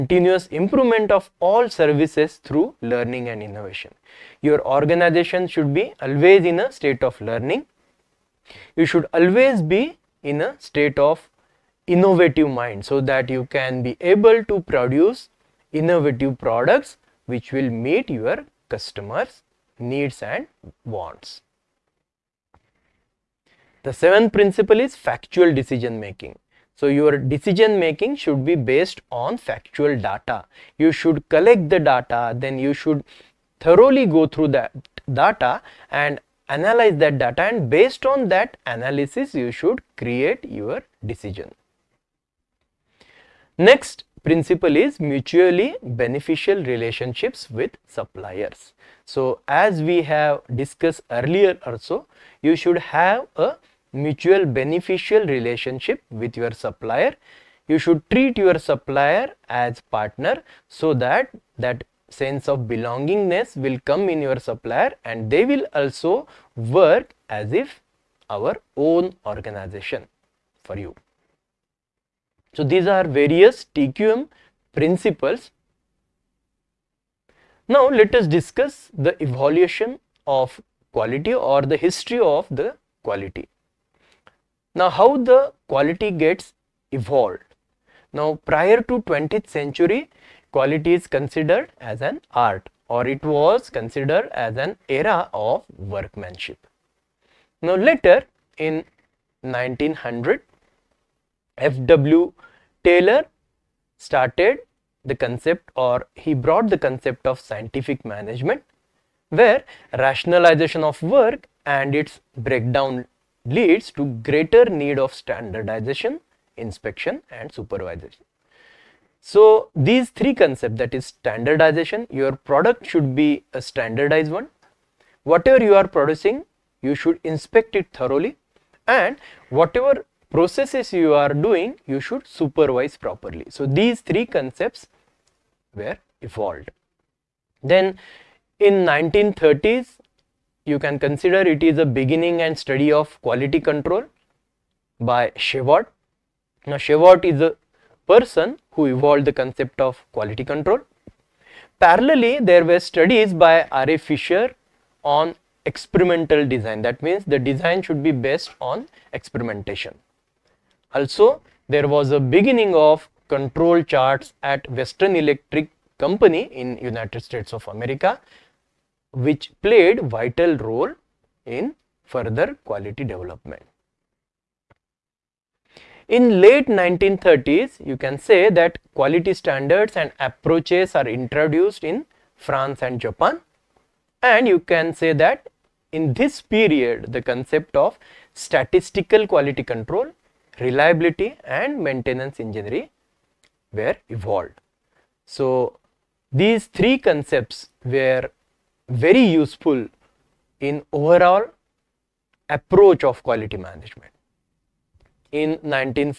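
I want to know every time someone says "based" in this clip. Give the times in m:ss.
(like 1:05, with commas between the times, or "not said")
0:28, 0:37, 2:38.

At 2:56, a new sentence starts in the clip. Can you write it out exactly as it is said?
In late 1930s, you can say that quality standards and approaches are introduced in France and Japan.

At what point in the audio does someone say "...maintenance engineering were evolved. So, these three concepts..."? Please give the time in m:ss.
3:11.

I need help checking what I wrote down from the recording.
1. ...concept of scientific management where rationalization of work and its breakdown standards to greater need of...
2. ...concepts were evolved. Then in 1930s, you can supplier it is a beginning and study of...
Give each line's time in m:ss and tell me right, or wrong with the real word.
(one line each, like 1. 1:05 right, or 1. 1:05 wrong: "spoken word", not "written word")
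1. 1:46 wrong: "leads", not "standards"
2. 2:14 wrong: "consider", not "supplier".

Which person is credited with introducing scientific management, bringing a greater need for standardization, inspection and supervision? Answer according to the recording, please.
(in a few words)
F.W. Taylor.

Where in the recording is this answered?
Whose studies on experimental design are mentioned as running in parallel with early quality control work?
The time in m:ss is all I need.
2:33.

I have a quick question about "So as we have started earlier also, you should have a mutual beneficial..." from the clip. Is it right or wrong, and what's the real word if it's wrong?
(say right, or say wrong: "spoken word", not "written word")
wrong: "discussed", not "started".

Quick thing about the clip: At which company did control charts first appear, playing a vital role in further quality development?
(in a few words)
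Western Electric Company.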